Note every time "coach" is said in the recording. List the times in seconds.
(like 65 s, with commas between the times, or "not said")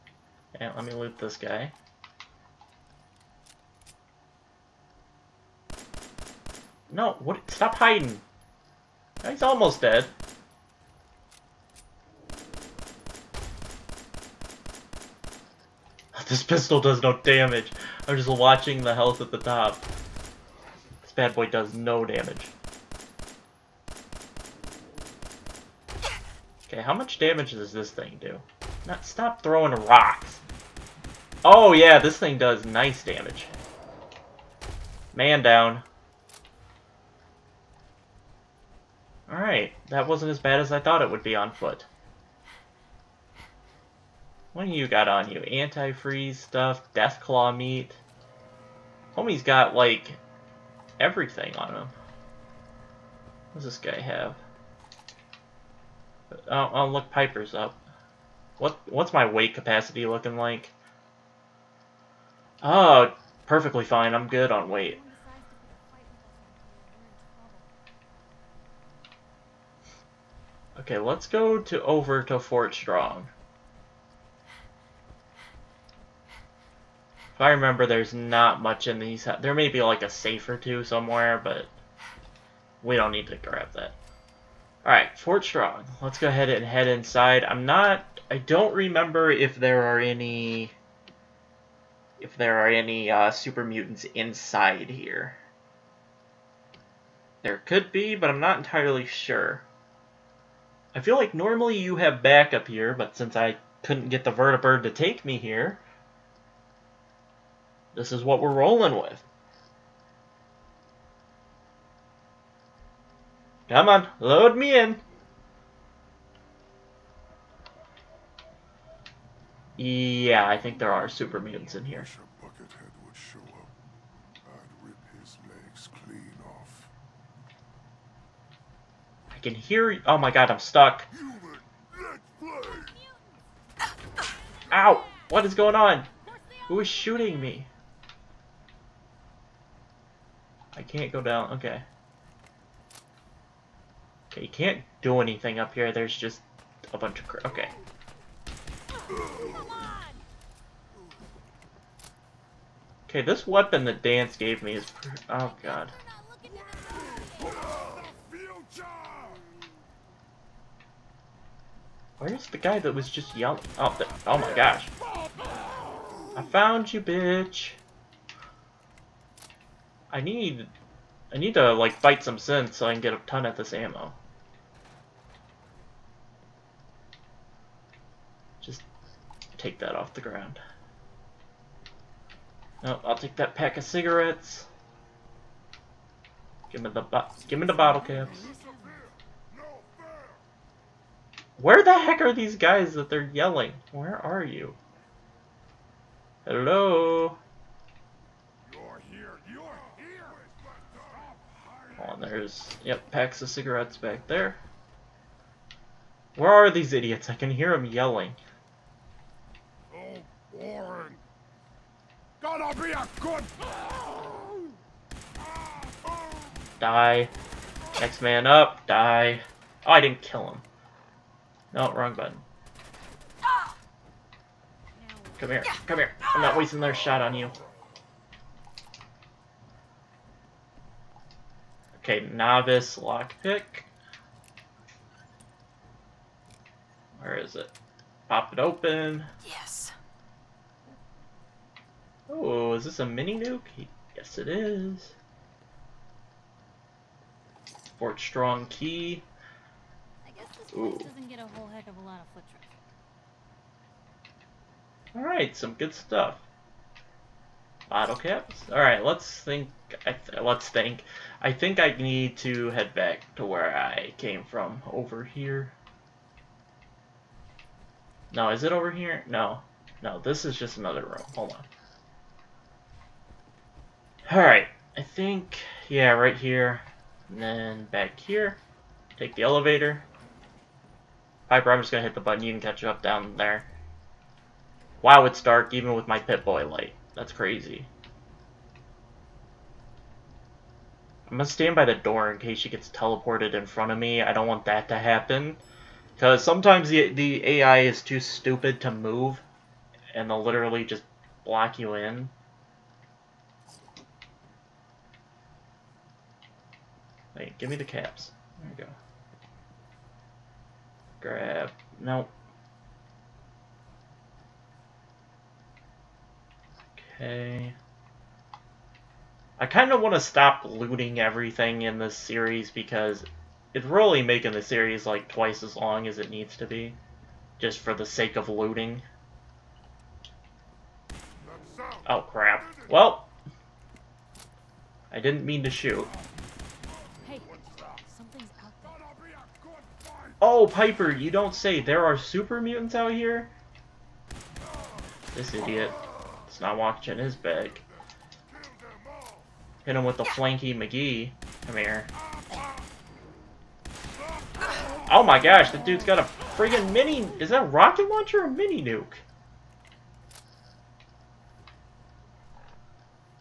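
not said.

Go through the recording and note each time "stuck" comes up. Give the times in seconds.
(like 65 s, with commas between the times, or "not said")
130 s.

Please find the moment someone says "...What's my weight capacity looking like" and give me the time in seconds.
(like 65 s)
58 s.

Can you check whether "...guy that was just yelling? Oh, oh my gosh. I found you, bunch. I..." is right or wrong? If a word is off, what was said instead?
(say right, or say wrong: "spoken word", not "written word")
wrong: "bitch", not "bunch".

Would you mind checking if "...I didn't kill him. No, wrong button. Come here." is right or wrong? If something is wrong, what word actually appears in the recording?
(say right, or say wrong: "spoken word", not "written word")
right.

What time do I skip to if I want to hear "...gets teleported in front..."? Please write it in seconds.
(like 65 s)
292 s.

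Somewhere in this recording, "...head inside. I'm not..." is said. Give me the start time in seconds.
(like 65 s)
86 s.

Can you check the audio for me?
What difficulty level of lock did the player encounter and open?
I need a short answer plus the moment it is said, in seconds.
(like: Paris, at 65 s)
novice, at 232 s.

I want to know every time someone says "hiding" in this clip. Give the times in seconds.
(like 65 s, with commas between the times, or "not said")
7 s.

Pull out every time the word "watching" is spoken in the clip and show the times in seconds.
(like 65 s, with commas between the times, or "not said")
18 s, 346 s.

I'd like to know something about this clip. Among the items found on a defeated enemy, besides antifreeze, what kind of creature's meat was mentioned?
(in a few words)
Deathclaw.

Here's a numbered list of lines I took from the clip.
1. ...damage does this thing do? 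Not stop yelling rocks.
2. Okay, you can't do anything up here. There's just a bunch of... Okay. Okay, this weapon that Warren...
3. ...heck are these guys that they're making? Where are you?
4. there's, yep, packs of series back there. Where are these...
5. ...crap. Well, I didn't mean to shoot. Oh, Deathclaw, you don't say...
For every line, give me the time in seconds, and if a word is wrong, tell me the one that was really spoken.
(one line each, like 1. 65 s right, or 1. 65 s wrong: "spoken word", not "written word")
1. 27 s wrong: "throwing", not "yelling"
2. 144 s wrong: "Danse", not "Warren"
3. 191 s wrong: "yelling", not "making"
4. 202 s wrong: "cigarettes", not "series"
5. 332 s wrong: "Piper", not "Deathclaw".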